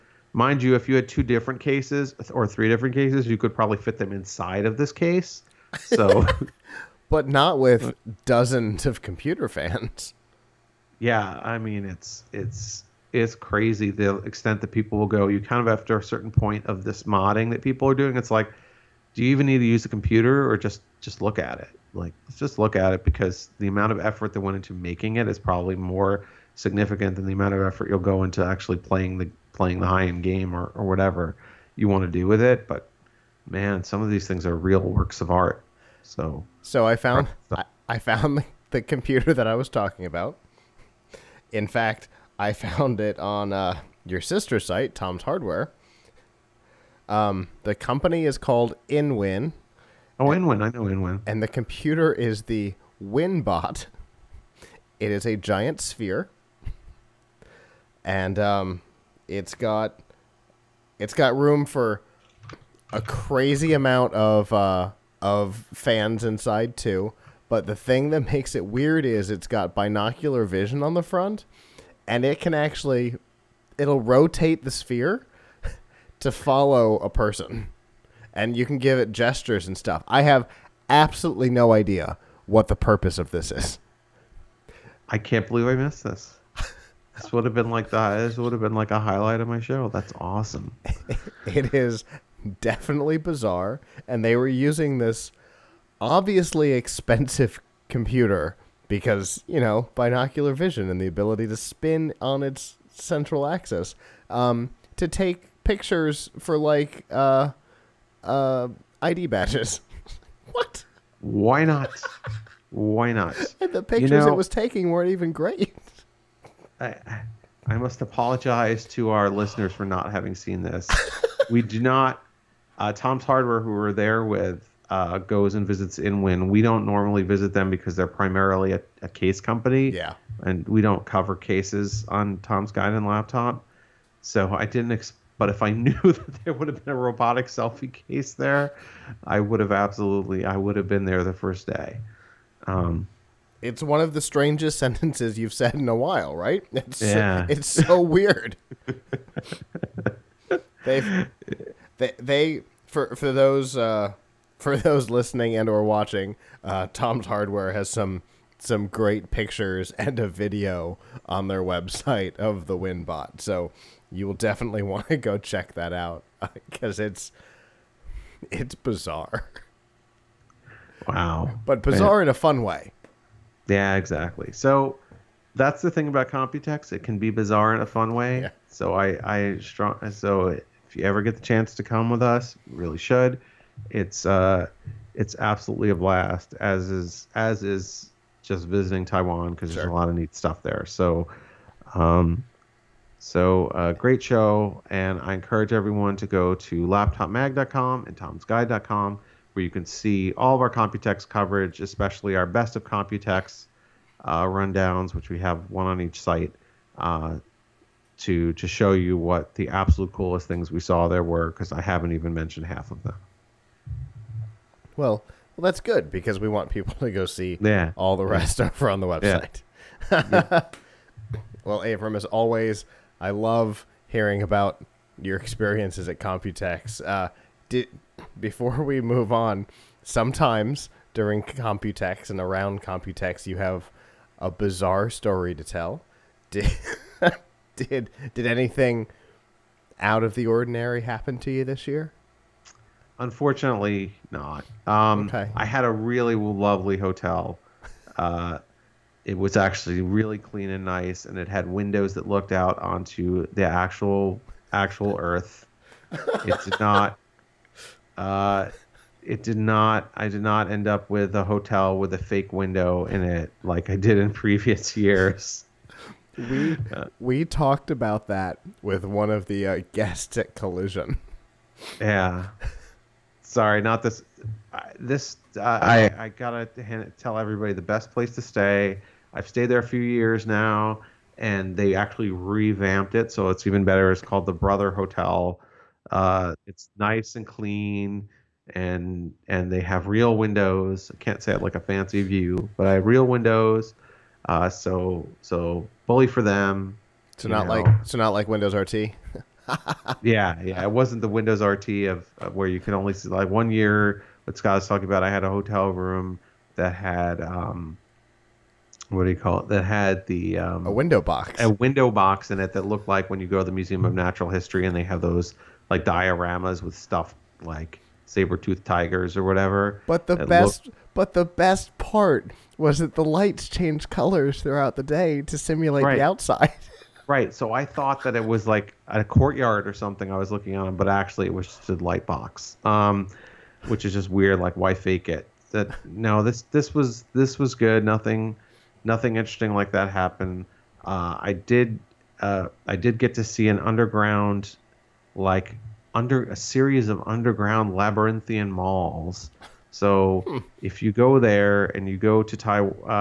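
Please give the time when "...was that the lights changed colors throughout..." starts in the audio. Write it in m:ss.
5:22.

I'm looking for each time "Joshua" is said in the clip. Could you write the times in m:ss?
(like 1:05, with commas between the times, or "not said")
not said.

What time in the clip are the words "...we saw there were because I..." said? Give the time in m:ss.
3:30.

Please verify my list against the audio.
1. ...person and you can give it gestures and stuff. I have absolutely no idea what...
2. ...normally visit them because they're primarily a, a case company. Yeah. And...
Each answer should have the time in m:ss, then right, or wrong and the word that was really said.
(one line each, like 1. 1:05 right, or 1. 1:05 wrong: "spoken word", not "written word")
1. 1:17 right
2. 2:06 right.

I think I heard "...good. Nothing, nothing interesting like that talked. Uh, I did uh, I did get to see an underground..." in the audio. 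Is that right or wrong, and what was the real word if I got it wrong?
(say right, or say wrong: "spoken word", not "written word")
wrong: "happened", not "talked".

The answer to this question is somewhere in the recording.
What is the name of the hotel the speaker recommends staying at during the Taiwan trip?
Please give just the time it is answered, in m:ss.
4:44.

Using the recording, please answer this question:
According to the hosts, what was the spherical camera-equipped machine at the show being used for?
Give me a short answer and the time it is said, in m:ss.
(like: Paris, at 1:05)
ID badges, at 1:49.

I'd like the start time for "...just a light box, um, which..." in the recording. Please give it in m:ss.
5:31.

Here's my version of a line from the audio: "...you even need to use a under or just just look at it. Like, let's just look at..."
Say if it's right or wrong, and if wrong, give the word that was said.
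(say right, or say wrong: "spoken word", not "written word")
wrong: "computer", not "under".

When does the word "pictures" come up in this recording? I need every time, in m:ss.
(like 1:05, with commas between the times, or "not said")
1:45, 1:53, 2:39.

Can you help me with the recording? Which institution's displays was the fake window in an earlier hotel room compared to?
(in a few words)
Museum of Natural History.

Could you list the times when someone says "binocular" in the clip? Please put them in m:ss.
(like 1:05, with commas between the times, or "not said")
1:09, 1:39.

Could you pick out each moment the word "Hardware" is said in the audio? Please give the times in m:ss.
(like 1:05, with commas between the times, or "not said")
0:45, 2:03, 2:37.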